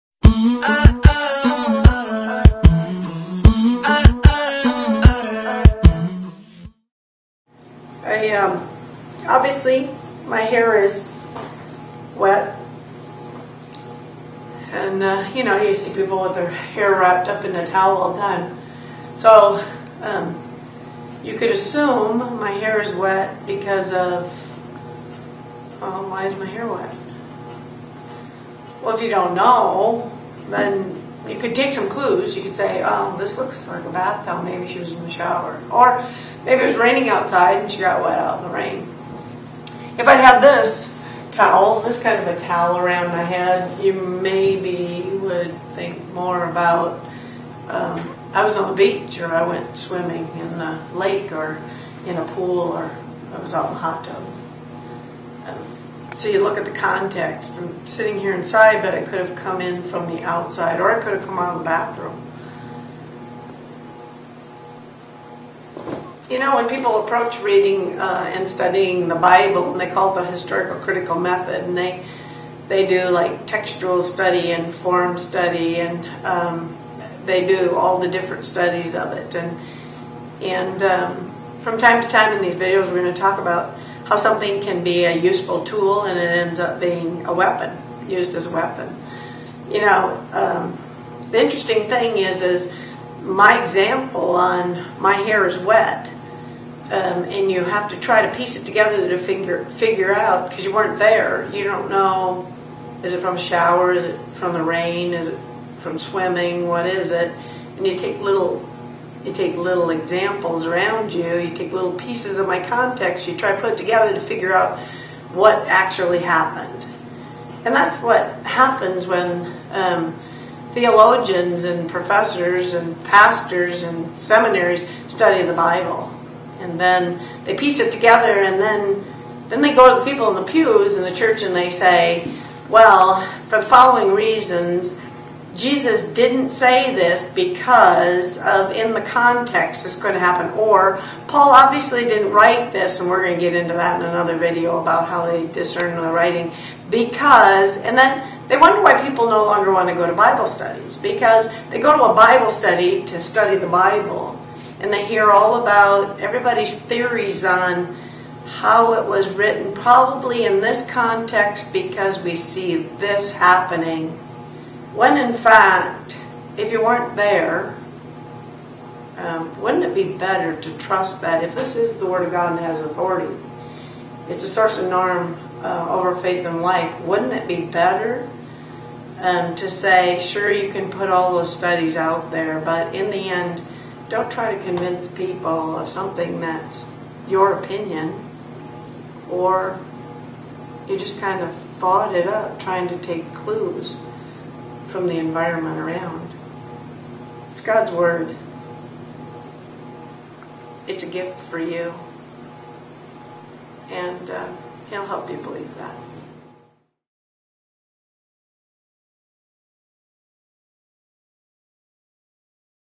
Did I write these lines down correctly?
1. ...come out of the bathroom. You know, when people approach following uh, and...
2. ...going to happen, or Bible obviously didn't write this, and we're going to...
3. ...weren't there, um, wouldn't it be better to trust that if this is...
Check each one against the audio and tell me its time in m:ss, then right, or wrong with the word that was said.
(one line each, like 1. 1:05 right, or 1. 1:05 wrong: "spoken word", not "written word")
1. 1:01 wrong: "reading", not "following"
2. 2:19 wrong: "Paul", not "Bible"
3. 2:46 right.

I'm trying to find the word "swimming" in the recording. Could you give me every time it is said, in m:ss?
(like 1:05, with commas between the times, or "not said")
0:49, 1:45.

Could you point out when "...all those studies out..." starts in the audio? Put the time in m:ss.
3:01.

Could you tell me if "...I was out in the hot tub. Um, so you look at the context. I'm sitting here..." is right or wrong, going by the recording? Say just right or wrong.
right.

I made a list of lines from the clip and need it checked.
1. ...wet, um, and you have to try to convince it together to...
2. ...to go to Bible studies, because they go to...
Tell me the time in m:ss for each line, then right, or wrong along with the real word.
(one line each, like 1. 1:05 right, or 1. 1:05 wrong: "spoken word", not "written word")
1. 1:35 wrong: "piece", not "convince"
2. 2:29 right.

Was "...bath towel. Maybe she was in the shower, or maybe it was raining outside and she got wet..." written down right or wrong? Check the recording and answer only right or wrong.
right.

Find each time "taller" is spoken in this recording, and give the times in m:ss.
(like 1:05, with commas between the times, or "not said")
not said.